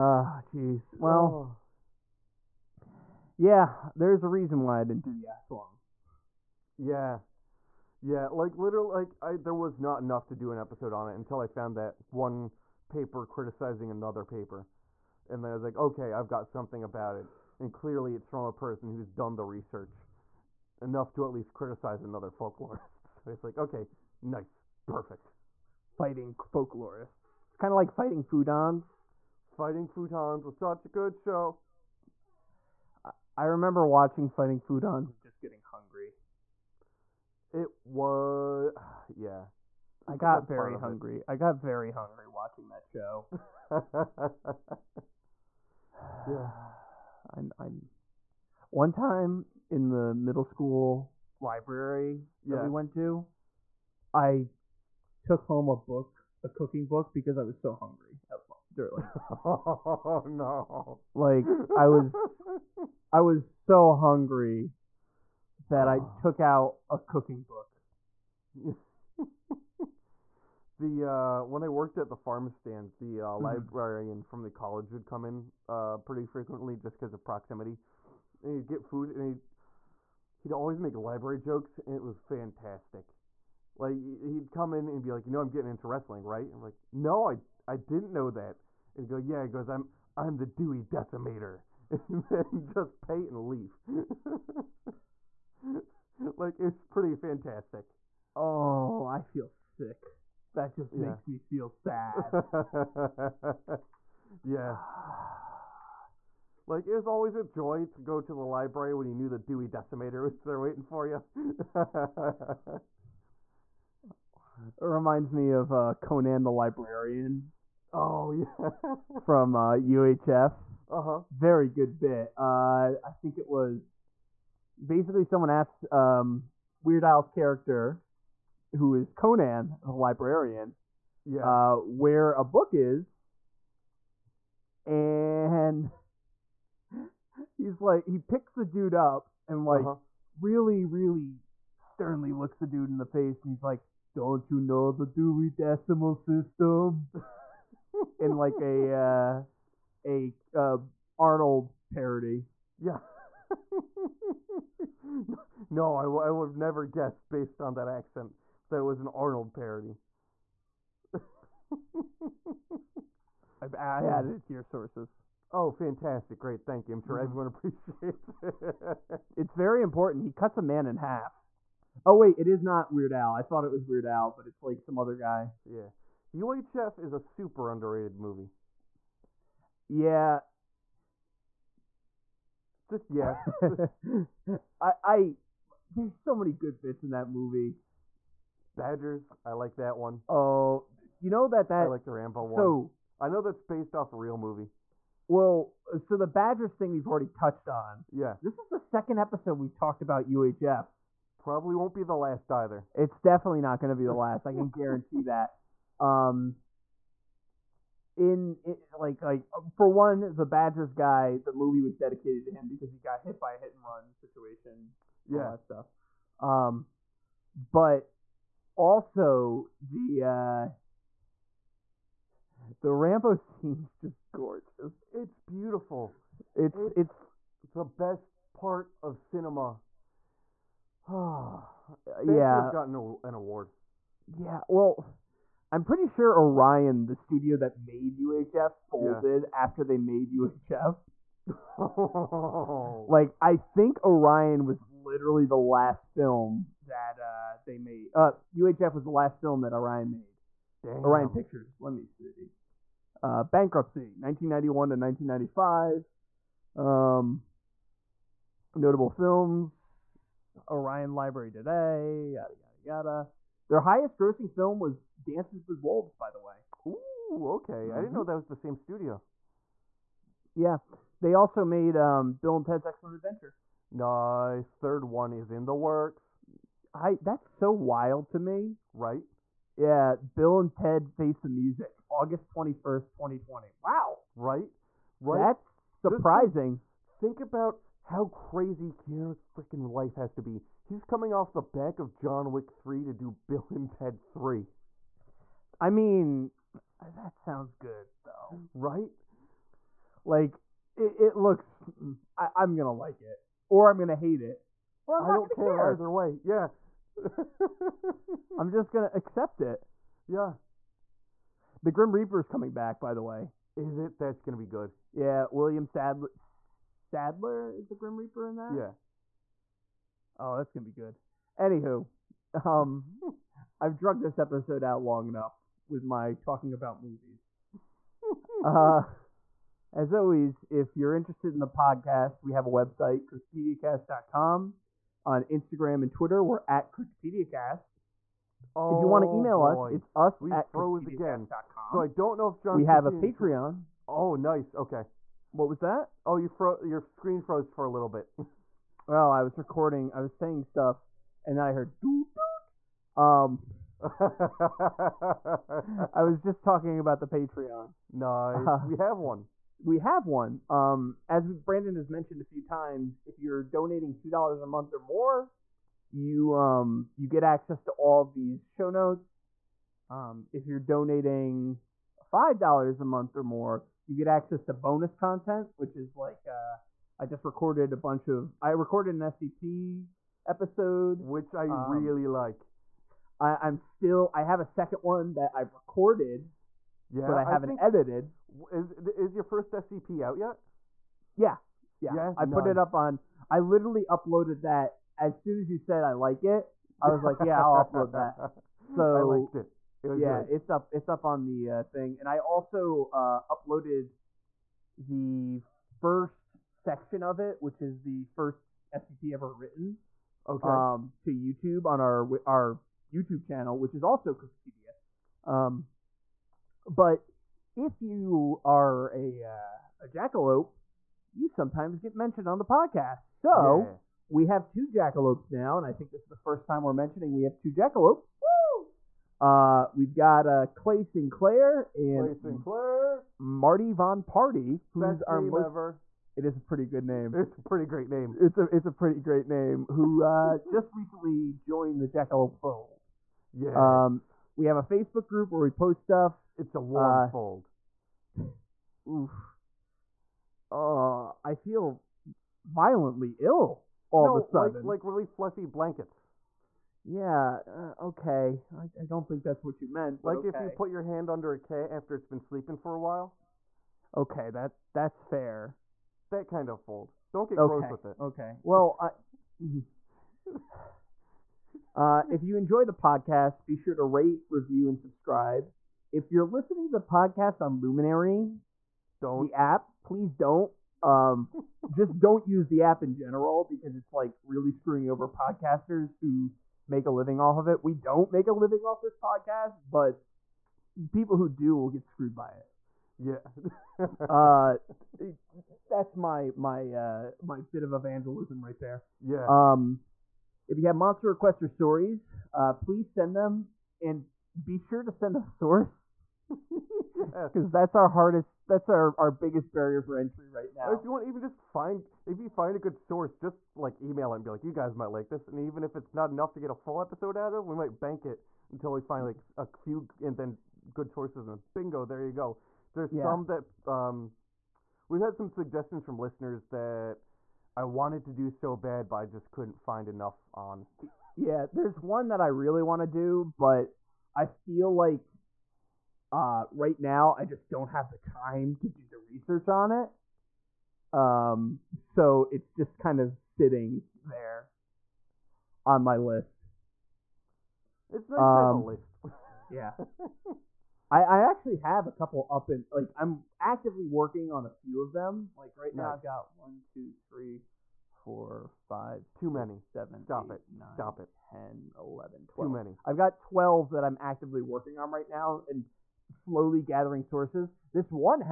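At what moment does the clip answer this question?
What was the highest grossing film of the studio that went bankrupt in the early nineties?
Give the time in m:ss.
4:25.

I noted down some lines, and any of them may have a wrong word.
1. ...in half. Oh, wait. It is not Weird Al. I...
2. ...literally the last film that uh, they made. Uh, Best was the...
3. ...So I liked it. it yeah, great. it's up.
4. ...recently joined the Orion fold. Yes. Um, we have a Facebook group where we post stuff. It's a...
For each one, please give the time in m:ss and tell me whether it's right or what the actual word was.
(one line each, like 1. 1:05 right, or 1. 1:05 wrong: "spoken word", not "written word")
1. 2:50 right
2. 4:05 wrong: "UHF", not "Best"
3. 6:38 right
4. 7:20 wrong: "Jackalope", not "Orion".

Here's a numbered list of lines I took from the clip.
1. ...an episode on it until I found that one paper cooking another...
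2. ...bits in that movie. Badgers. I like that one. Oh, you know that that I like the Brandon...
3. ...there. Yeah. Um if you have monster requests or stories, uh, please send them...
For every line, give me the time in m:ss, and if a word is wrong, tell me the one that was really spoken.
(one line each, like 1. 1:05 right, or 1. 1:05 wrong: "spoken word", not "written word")
1. 0:10 wrong: "criticizing", not "cooking"
2. 3:06 wrong: "Rambo", not "Brandon"
3. 8:18 right.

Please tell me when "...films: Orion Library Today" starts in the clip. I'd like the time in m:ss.
4:19.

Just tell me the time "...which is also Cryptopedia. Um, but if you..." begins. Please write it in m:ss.
6:53.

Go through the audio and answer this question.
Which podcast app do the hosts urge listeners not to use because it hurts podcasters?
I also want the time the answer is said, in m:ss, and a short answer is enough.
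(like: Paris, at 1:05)
Luminary, at 7:57.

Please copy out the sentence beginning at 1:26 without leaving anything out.
And we like, no, I I didn't know that.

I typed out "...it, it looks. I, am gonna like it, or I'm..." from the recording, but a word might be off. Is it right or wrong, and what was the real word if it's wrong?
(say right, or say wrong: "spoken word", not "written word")
right.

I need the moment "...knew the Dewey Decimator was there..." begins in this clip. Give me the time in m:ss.
1:49.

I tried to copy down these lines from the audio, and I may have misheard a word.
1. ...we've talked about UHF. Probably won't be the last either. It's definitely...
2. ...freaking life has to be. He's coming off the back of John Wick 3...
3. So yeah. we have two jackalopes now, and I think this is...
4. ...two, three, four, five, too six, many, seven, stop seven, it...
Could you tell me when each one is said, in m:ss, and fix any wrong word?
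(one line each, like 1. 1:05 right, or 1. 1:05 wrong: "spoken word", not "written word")
1. 3:19 right
2. 4:49 right
3. 7:03 right
4. 9:16 wrong: "eight", not "seven".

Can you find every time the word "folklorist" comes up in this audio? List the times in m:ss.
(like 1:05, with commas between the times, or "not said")
0:22, 0:26.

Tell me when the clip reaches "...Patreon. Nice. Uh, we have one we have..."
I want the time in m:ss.
5:57.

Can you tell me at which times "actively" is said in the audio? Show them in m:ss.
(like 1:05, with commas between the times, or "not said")
9:13, 9:24.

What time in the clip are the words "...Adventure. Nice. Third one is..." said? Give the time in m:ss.
4:33.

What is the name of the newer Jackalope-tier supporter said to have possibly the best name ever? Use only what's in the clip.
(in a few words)
Marty Von Party.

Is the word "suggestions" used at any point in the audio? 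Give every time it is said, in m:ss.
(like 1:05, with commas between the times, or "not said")
8:45.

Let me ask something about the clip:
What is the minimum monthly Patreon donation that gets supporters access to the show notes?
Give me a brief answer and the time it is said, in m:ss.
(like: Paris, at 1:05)
2 dollars, at 6:04.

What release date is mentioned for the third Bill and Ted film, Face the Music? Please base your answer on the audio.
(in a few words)
August 21st, 2020.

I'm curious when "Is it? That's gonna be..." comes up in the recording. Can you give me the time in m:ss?
5:13.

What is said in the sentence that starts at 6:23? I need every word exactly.
I, I'm still I have a second one that I've recorded, yeah, but I haven't I think...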